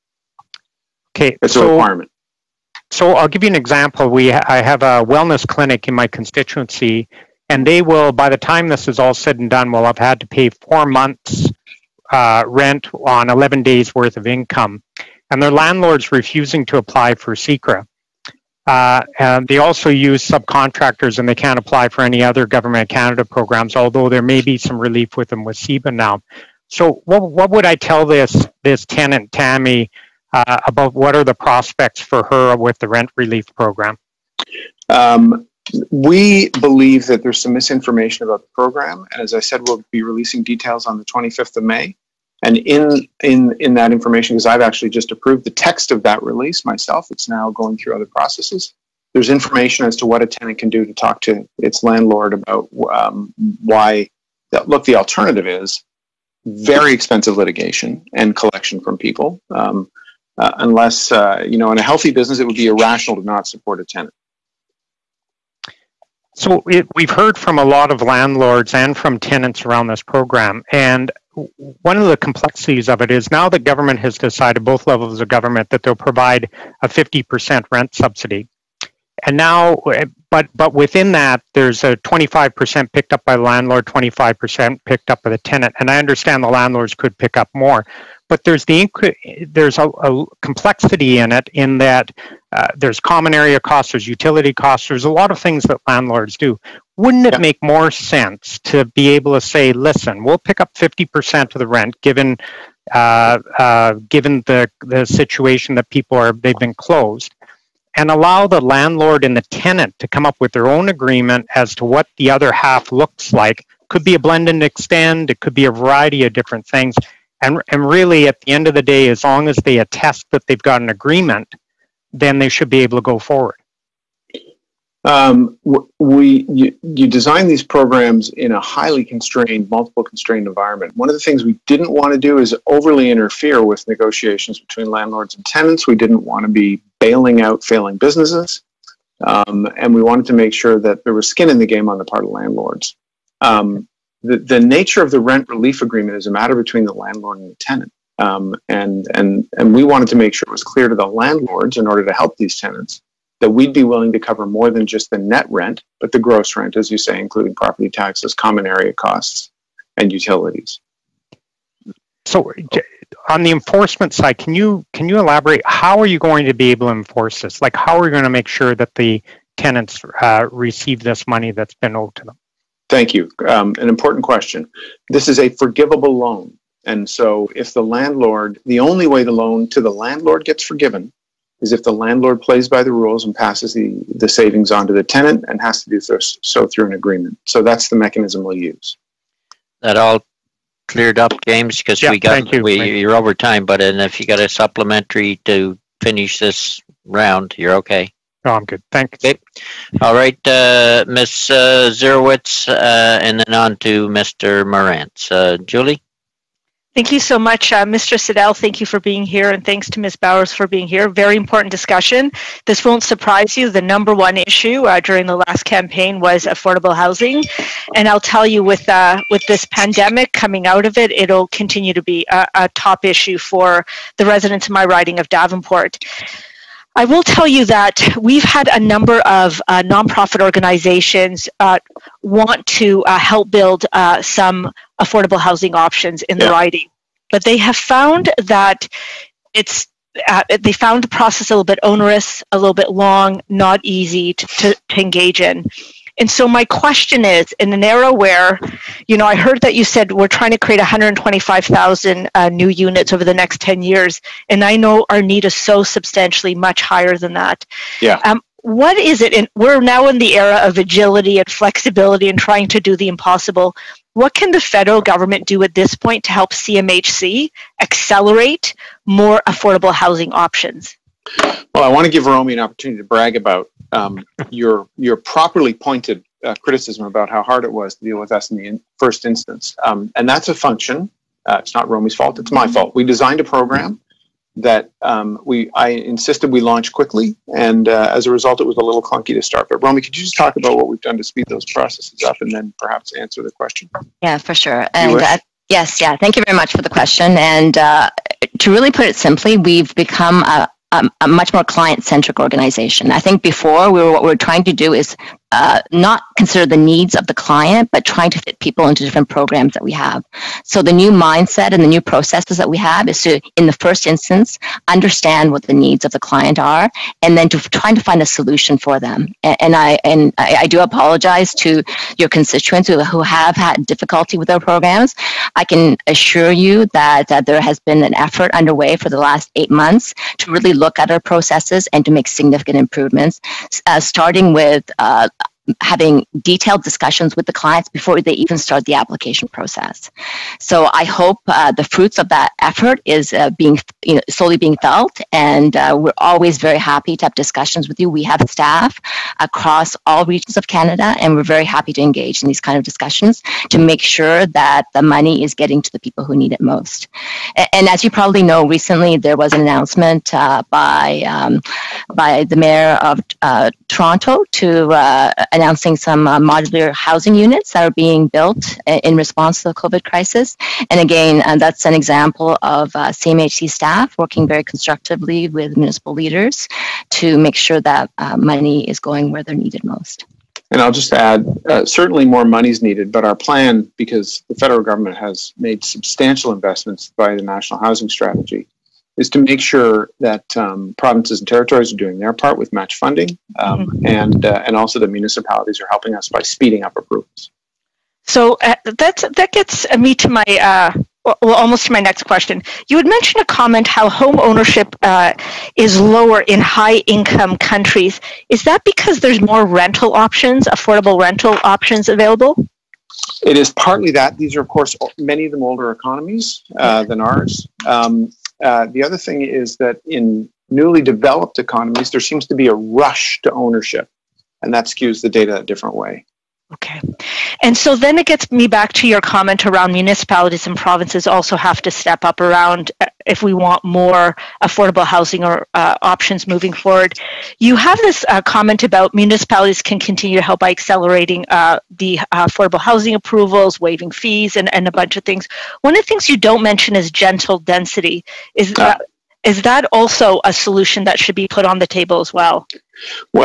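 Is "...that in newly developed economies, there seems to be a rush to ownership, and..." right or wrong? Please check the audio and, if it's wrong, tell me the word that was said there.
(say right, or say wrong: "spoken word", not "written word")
right.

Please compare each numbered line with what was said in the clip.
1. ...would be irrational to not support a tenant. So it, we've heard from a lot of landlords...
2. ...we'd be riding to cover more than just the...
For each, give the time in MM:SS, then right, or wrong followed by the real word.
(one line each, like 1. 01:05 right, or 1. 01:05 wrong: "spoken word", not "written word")
1. 01:02 right
2. 02:33 wrong: "willing", not "riding".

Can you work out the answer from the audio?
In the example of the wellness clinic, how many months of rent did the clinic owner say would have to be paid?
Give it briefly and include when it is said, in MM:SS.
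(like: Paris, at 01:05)
4 months, at 00:10.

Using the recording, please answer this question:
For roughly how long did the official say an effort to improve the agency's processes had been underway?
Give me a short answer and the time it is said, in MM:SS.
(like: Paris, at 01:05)
8 months, at 05:29.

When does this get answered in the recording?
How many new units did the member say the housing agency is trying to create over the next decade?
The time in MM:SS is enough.
04:10.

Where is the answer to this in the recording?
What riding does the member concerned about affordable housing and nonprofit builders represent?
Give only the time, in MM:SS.
03:45.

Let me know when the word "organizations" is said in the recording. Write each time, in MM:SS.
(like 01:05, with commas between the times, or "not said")
03:50, 05:02.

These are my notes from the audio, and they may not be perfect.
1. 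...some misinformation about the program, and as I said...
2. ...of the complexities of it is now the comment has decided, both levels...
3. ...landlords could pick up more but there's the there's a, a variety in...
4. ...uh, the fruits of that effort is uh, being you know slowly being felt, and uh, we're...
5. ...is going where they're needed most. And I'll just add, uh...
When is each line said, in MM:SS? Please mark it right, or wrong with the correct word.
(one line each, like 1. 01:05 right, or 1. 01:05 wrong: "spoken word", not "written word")
1. 00:37 right
2. 01:11 wrong: "government", not "comment"
3. 01:26 wrong: "complexity", not "variety"
4. 05:41 right
5. 06:18 right.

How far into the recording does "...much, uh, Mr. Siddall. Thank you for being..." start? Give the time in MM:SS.
03:27.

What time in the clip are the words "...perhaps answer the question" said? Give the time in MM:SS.
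04:52.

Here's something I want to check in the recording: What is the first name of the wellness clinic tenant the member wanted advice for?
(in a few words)
Tammy.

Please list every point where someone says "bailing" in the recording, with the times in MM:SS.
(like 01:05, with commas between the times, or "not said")
02:16.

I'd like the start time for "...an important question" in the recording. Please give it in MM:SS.
02:53.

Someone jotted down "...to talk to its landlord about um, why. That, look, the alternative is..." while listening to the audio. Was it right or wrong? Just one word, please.
right.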